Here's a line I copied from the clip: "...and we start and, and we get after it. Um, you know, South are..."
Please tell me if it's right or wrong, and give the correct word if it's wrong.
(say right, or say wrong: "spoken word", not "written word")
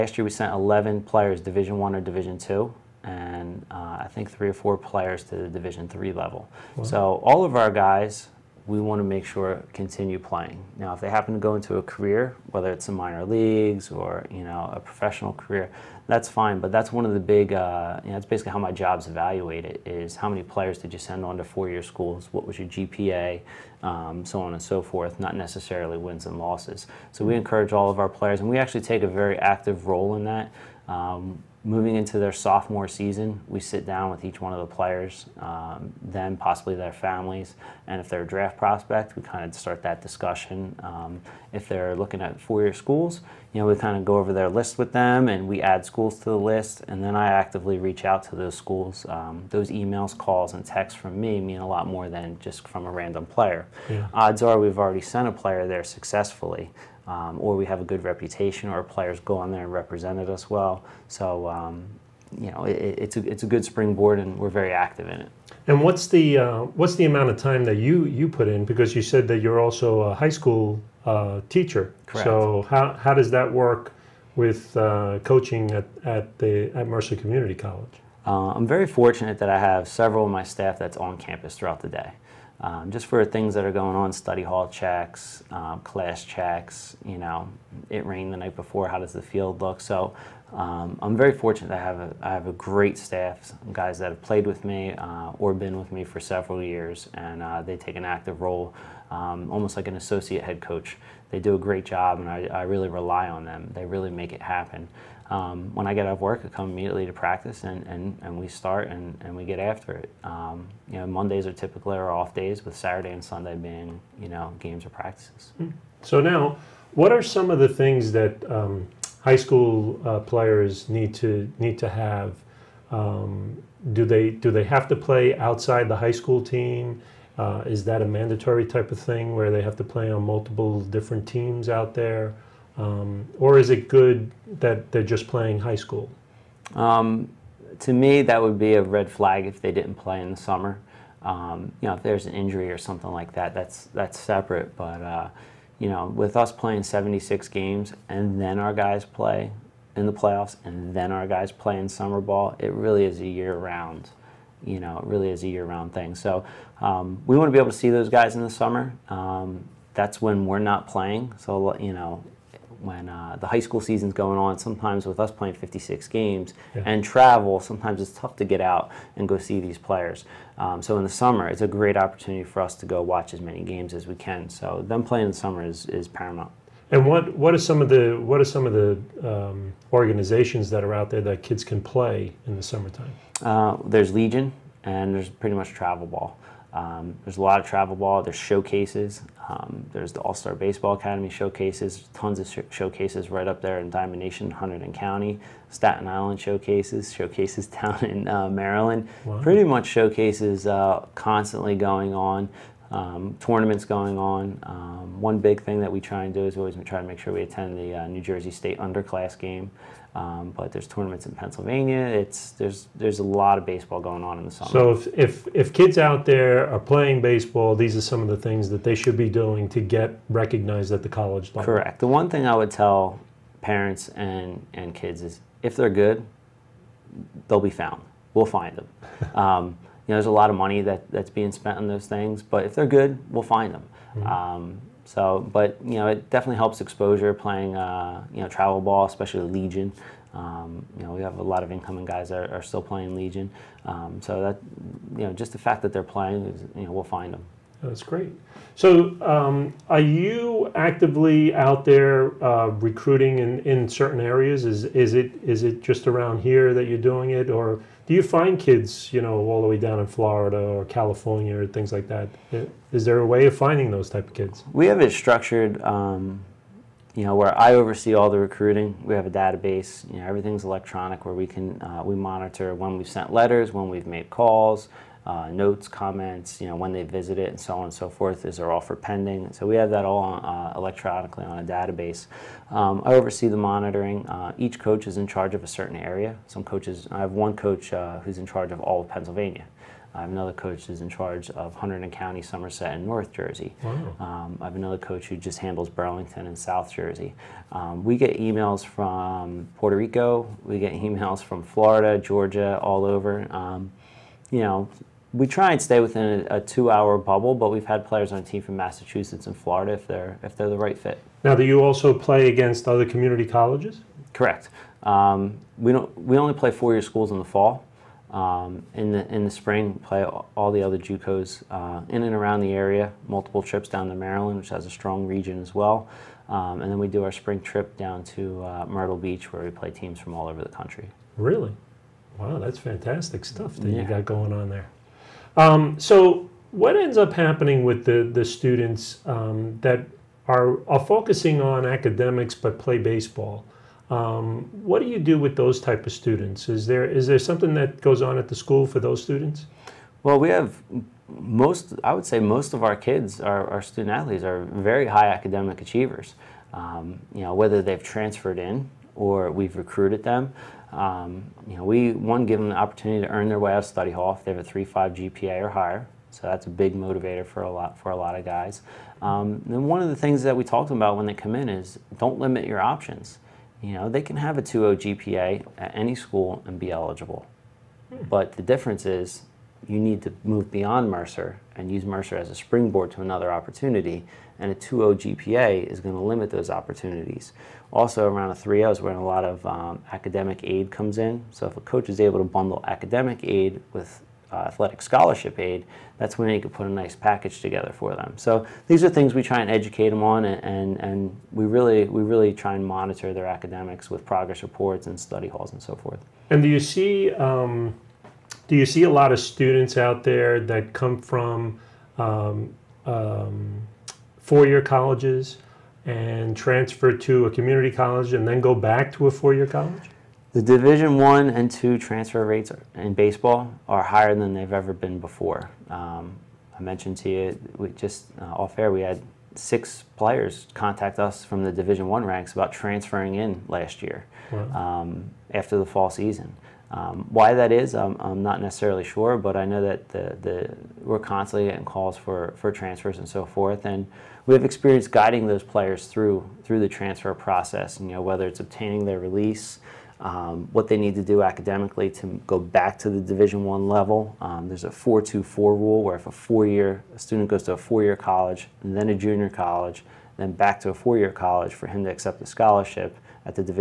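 wrong: "Mondays", not "South".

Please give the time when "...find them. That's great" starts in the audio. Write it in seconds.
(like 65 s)
247 s.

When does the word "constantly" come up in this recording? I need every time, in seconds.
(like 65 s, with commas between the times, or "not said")
201 s, 441 s.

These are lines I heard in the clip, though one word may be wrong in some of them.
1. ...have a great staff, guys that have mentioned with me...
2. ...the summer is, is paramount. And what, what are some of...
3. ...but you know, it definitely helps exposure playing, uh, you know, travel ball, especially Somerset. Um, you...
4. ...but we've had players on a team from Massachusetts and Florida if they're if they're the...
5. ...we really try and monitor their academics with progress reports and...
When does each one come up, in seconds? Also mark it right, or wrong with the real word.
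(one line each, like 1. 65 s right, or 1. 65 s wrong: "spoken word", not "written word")
1. 92 s wrong: "played", not "mentioned"
2. 175 s right
3. 235 s wrong: "Legion", not "Somerset"
4. 307 s right
5. 402 s right.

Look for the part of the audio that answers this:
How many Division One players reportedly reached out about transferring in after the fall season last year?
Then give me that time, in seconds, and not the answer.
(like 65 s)
429 s.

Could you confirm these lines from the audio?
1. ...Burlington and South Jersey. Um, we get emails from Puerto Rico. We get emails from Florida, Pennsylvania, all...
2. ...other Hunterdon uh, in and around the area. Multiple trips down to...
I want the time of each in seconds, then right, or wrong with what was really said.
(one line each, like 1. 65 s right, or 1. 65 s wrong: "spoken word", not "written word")
1. 295 s wrong: "Georgia", not "Pennsylvania"
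2. 320 s wrong: "JUCOs", not "Hunterdon".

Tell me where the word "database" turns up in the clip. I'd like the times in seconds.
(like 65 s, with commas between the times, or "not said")
269 s, 281 s.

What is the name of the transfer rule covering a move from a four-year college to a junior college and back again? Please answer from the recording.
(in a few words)
4-2-4 rule.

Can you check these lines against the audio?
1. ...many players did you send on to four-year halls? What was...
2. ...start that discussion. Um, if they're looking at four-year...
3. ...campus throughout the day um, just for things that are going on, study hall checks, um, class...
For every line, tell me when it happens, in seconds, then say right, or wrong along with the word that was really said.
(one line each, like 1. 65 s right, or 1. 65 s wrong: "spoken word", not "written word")
1. 20 s wrong: "schools", not "halls"
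2. 39 s right
3. 81 s right.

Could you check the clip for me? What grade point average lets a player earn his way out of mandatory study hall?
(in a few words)
3.5.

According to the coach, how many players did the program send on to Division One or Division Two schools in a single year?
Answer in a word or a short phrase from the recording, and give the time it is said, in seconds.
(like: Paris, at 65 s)
11, at 0 s.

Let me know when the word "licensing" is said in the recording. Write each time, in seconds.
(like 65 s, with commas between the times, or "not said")
not said.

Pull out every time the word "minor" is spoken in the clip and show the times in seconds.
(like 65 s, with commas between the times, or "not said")
12 s.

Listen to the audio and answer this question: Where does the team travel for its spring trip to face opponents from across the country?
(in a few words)
Myrtle Beach.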